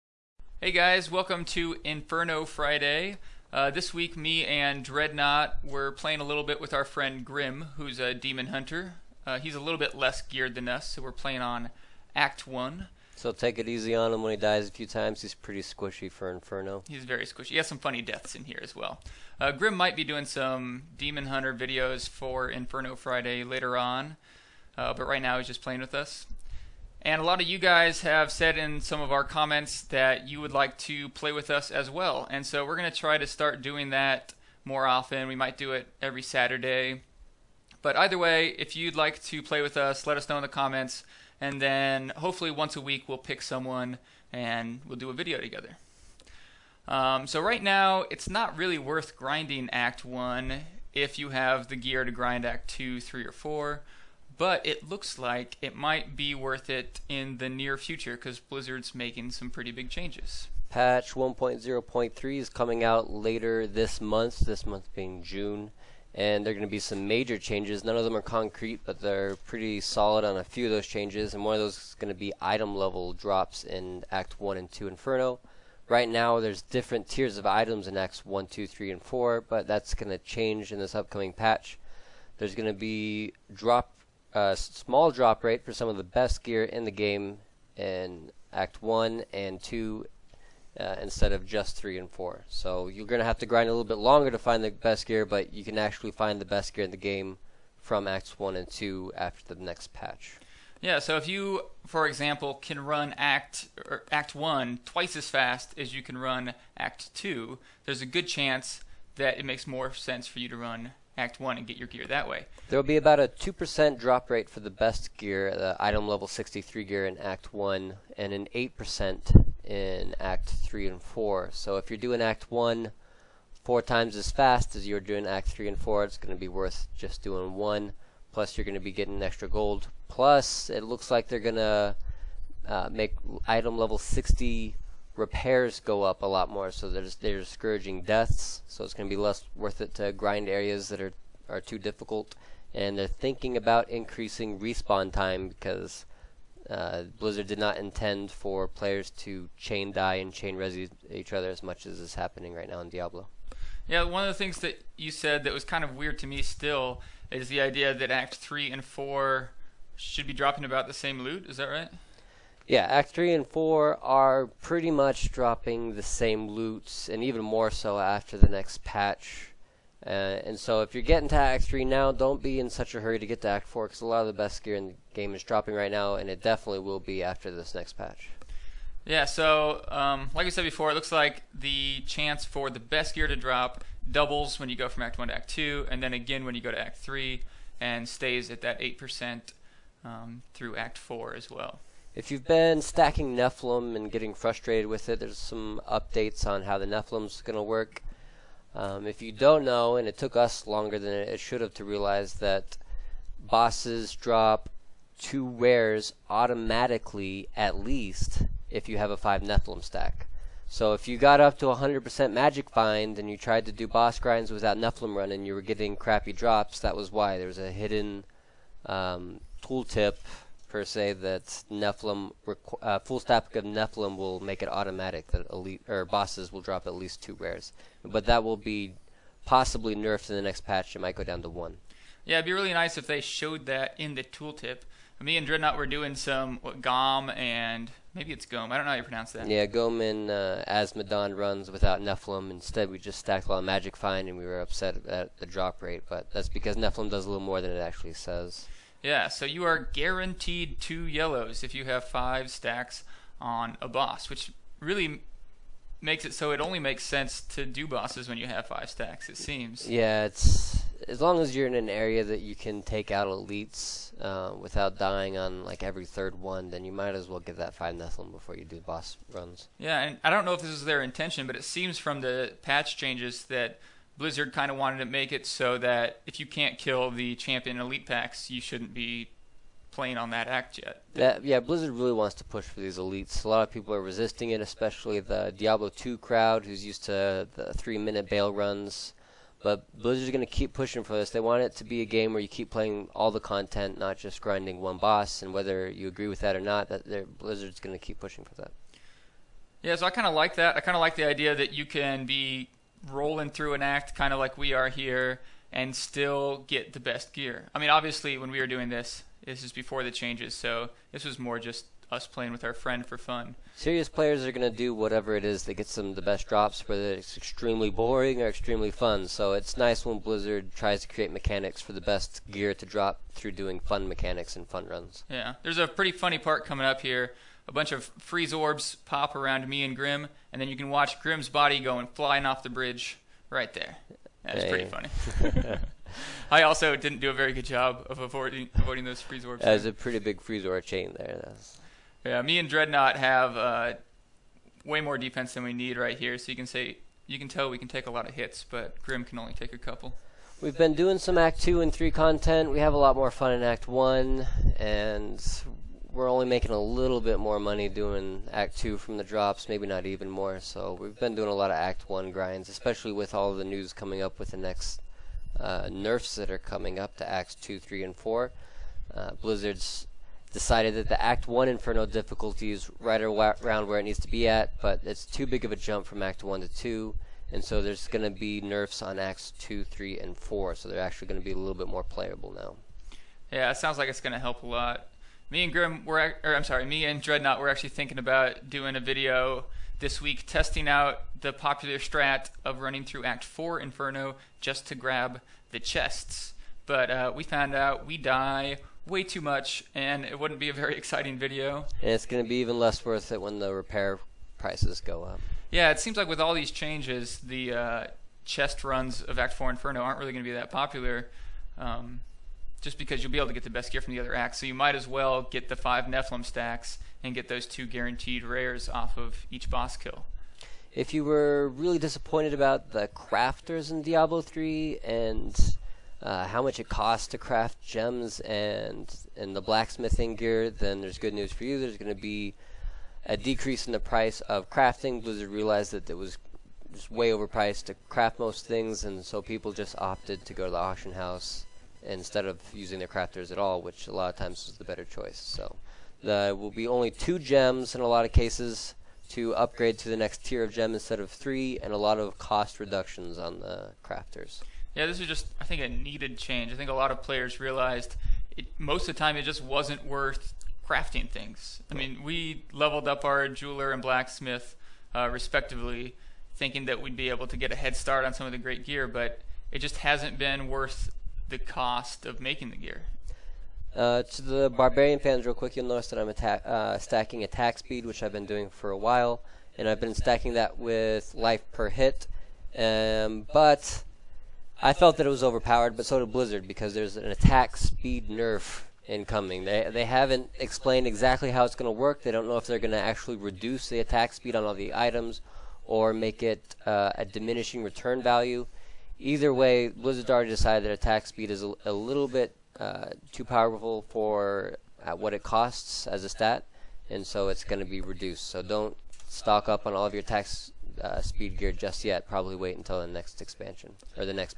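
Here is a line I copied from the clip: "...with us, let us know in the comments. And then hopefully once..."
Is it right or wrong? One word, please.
right.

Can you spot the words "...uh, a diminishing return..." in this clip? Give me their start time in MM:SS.
08:16.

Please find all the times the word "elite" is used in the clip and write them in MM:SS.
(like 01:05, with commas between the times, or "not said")
03:45, 04:23, 04:37, 04:42.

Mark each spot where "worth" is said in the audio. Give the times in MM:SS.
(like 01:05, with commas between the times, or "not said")
00:48, 00:56, 02:06, 02:19, 06:43, 07:40, 07:50.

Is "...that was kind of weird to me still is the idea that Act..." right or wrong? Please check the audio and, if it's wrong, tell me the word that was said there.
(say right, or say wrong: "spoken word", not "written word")
right.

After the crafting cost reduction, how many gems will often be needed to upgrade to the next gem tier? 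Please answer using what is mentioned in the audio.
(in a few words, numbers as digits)
2.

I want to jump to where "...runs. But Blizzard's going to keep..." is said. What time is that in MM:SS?
04:48.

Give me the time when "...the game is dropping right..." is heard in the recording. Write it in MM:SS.
02:54.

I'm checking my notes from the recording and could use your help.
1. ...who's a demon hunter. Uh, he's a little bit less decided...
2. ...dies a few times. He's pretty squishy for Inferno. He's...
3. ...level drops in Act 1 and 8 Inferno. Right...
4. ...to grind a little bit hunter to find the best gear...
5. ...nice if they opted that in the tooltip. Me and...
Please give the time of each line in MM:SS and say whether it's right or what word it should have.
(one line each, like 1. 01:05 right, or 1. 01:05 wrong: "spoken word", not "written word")
1. 00:07 wrong: "geared", not "decided"
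2. 00:14 right
3. 01:12 wrong: "2", not "8"
4. 01:33 wrong: "longer", not "hunter"
5. 03:52 wrong: "showed", not "opted".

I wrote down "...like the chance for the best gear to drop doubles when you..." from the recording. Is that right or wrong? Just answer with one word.
right.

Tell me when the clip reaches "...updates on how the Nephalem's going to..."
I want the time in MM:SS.
03:15.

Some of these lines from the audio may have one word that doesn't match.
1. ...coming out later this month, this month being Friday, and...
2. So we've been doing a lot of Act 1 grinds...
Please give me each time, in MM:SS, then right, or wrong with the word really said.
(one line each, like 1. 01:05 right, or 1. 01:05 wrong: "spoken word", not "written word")
1. 01:02 wrong: "June", not "Friday"
2. 06:00 right.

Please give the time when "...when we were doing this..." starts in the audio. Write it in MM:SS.
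05:08.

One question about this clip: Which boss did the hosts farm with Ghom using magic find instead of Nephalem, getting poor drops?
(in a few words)
Azmodan.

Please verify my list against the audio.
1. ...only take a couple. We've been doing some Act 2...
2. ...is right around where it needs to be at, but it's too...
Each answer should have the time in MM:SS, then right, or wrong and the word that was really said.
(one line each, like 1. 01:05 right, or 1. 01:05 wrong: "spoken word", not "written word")
1. 05:49 right
2. 06:12 right.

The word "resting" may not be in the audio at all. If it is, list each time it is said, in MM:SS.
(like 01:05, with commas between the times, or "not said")
not said.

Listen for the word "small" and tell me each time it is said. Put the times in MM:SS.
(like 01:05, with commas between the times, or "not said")
01:24.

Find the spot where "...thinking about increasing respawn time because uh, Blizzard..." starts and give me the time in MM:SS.
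02:23.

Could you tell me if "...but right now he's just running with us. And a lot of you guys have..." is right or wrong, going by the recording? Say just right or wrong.
wrong.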